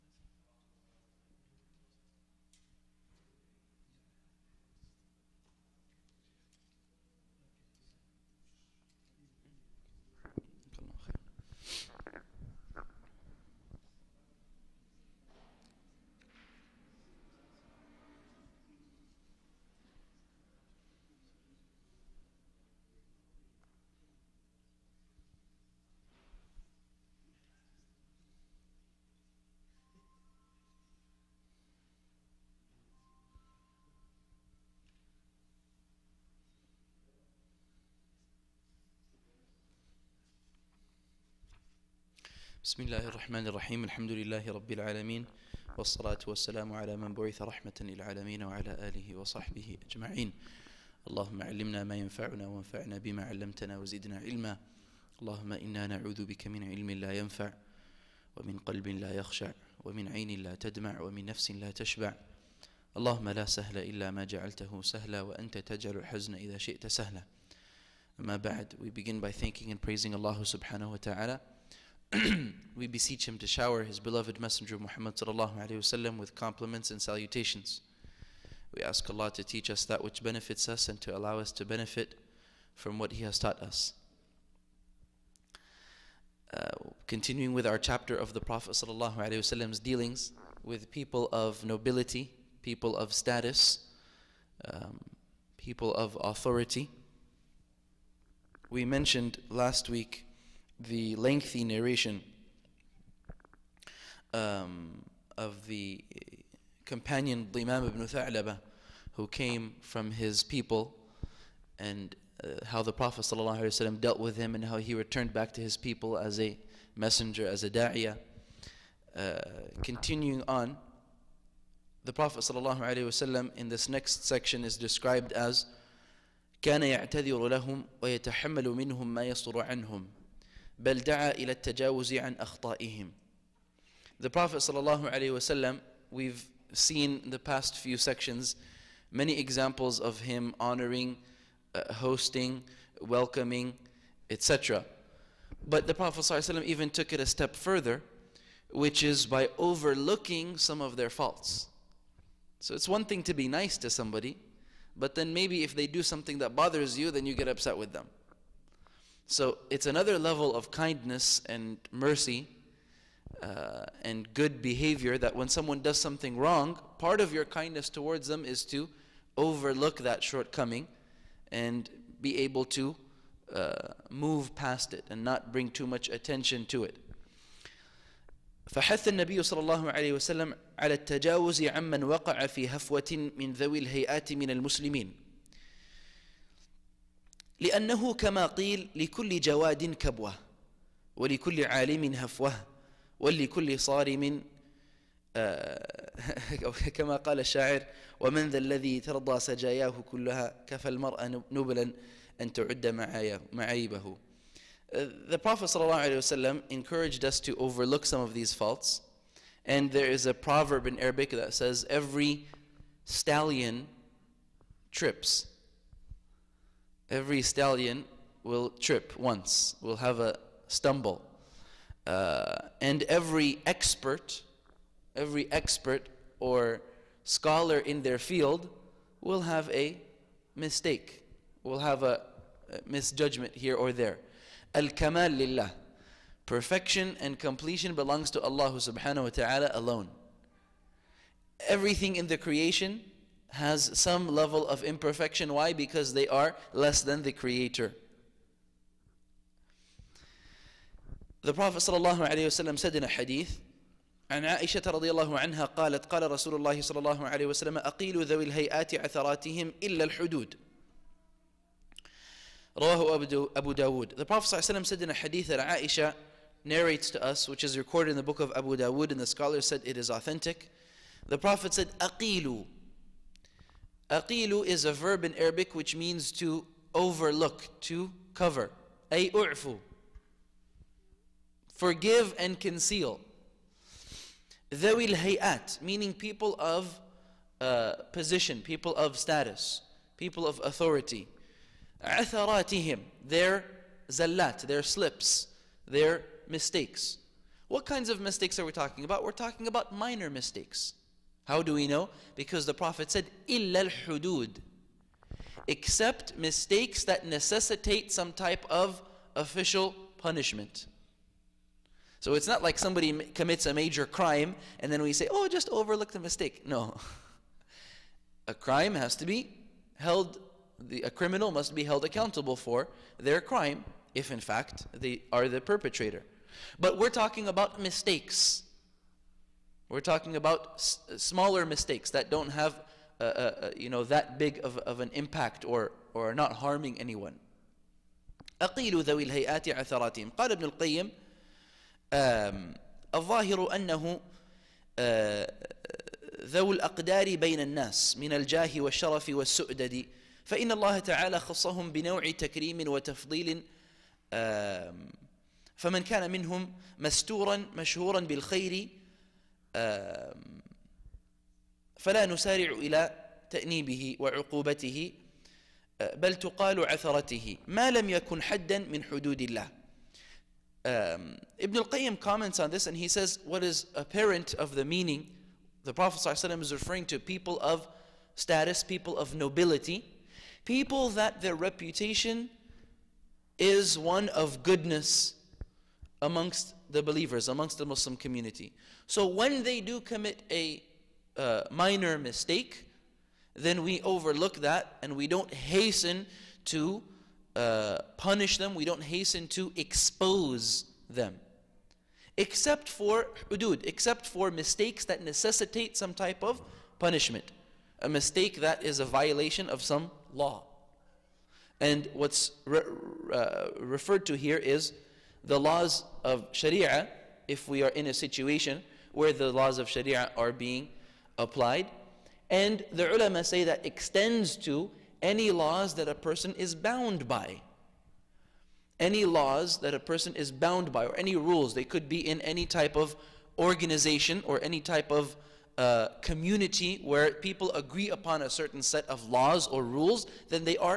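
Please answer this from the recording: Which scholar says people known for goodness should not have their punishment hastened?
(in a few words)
Ibn al-Qayyim.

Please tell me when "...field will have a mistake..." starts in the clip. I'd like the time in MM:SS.
03:48.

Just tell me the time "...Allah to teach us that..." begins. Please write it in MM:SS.
01:19.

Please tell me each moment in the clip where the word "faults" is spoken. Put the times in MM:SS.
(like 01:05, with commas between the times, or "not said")
02:31, 03:28.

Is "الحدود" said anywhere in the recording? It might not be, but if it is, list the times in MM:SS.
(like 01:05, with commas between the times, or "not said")
04:20, 05:03.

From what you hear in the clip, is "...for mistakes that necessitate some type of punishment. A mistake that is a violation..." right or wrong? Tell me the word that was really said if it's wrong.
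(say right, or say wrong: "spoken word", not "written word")
right.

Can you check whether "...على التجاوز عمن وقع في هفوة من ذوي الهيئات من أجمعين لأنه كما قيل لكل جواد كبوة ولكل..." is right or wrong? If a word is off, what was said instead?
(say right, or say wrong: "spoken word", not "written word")
wrong: "المسلمين", not "أجمعين".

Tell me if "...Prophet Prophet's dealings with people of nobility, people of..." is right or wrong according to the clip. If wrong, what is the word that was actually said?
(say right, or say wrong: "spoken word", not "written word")
right.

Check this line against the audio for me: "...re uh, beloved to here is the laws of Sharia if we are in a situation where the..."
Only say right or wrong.
wrong.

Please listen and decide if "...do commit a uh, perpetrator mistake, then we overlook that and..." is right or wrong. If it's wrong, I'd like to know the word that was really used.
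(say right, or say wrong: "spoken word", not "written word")
wrong: "minor", not "perpetrator".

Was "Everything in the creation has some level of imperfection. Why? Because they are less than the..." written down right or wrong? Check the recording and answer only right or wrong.
right.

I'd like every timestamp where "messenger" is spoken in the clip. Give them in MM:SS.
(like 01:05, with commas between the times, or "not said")
01:14, 01:56.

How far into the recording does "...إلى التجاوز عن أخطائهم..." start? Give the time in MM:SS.
02:11.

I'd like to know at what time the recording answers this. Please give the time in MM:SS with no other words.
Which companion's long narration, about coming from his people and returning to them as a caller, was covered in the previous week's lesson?
01:47.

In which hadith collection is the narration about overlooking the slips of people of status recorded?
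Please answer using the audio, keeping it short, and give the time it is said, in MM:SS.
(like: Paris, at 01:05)
Abu Dawud, at 04:22.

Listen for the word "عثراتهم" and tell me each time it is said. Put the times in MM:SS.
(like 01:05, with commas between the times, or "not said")
04:18, 05:39.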